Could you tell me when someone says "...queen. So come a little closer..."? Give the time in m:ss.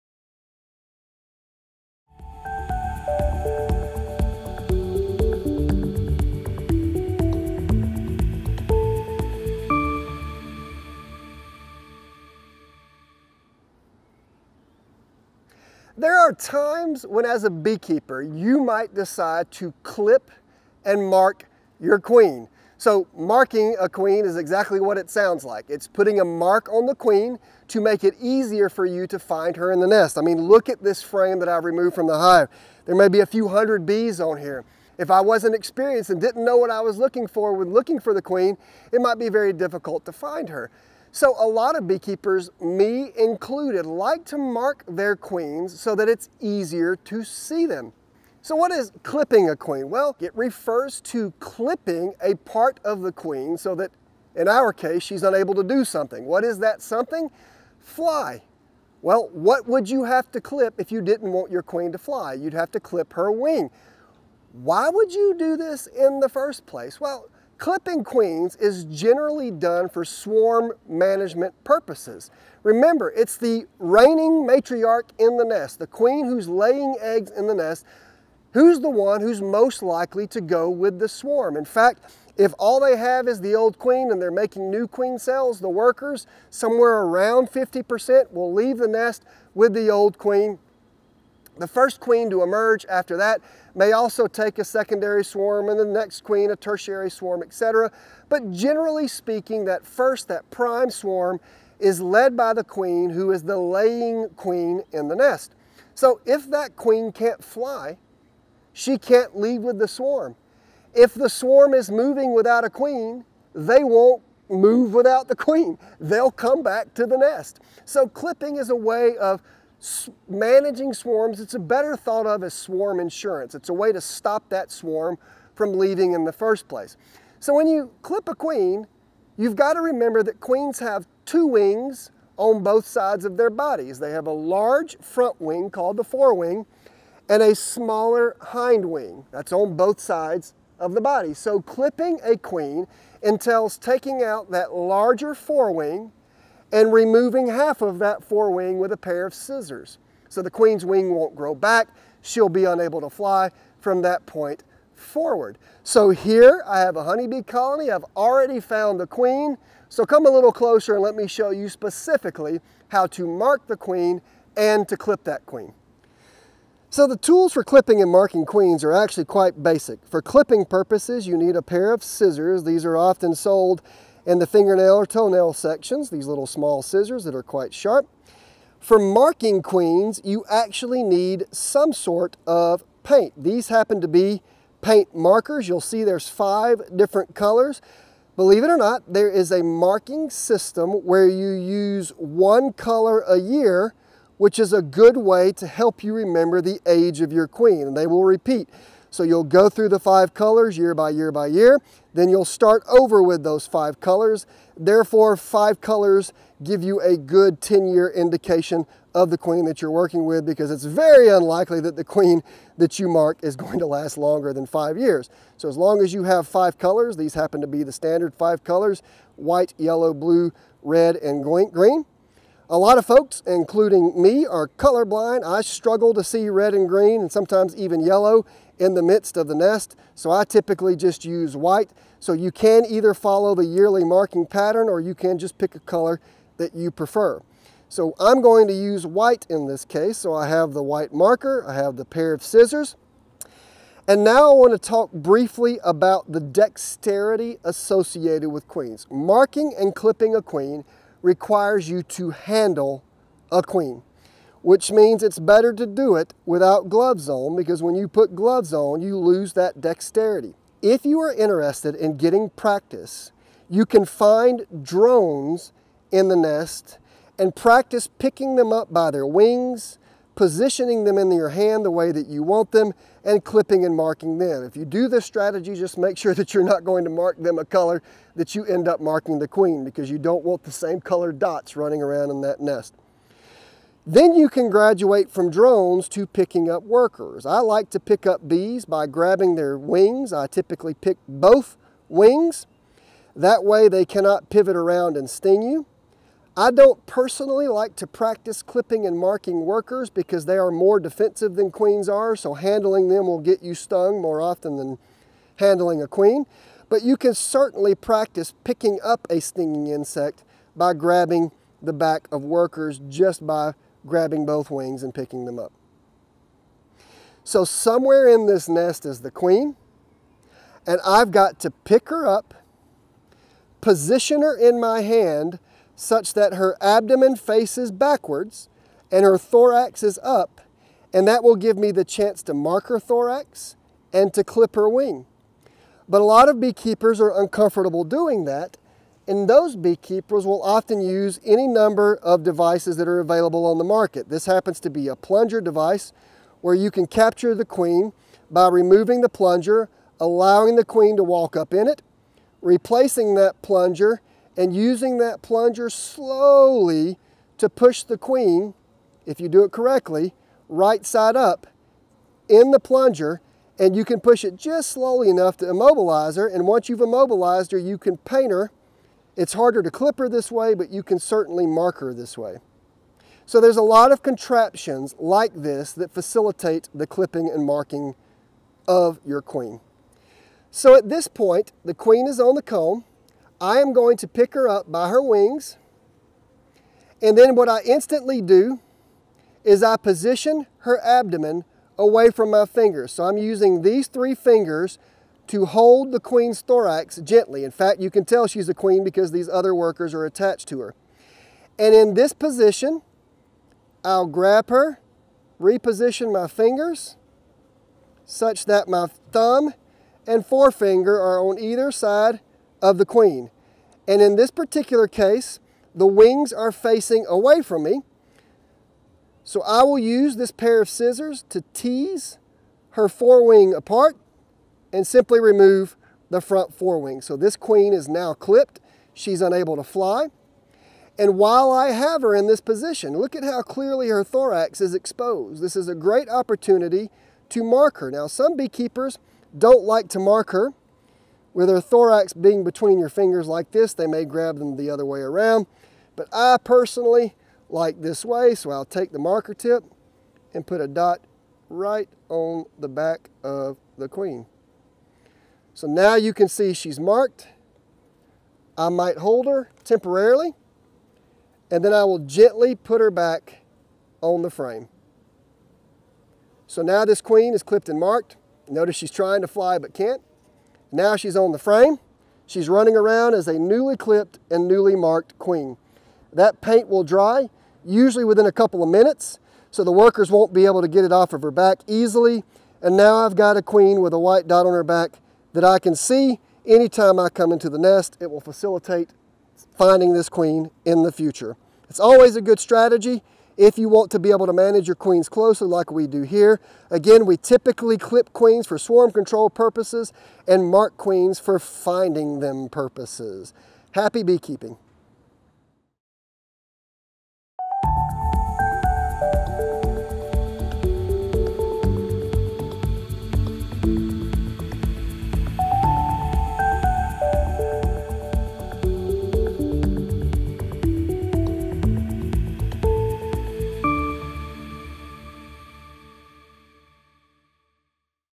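2:39.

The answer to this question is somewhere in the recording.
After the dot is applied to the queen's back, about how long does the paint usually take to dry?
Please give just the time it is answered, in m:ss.
7:58.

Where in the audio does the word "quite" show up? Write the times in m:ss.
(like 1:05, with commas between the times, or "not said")
2:49, 2:57.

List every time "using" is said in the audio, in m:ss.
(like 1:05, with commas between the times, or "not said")
5:54, 6:33.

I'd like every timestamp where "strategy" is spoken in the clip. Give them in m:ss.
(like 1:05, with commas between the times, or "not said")
4:35, 8:12.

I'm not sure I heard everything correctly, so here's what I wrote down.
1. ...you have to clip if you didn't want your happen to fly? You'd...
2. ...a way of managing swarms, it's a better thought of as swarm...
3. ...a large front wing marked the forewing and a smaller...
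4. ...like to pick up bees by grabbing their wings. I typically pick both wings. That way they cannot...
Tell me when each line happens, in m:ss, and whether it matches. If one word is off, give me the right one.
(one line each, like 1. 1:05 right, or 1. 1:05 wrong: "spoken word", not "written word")
1. 0:59 wrong: "queen", not "happen"
2. 1:58 right
3. 2:14 wrong: "called", not "marked"
4. 4:47 right.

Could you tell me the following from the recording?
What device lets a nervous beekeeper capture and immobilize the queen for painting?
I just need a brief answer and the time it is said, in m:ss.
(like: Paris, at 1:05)
plunger device, at 5:45.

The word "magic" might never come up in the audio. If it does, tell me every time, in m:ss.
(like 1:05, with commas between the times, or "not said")
not said.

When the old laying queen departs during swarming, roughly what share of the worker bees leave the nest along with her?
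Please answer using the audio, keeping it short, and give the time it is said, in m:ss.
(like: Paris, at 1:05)
50%, at 1:27.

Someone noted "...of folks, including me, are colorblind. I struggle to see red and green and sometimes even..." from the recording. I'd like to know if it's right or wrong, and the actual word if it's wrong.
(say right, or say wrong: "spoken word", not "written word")
right.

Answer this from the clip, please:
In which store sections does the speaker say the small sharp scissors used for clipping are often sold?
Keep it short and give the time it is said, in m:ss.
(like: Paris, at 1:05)
fingernail or toenail sections, at 2:54.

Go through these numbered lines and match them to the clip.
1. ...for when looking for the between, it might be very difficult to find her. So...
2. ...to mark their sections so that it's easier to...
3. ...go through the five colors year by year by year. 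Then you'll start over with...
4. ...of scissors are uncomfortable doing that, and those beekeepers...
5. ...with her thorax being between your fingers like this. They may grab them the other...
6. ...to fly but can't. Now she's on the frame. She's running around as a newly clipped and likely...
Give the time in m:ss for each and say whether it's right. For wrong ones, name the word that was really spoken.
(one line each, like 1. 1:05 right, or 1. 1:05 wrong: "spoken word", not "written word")
1. 0:37 wrong: "queen", not "between"
2. 0:44 wrong: "queens", not "sections"
3. 3:19 right
4. 5:36 wrong: "beekeepers", not "scissors"
5. 7:21 right
6. 7:49 wrong: "newly", not "likely".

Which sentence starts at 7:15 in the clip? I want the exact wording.
This is a great opportunity to mark her.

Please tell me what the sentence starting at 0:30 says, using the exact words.
I mean, look at this frame that I've removed from the hive.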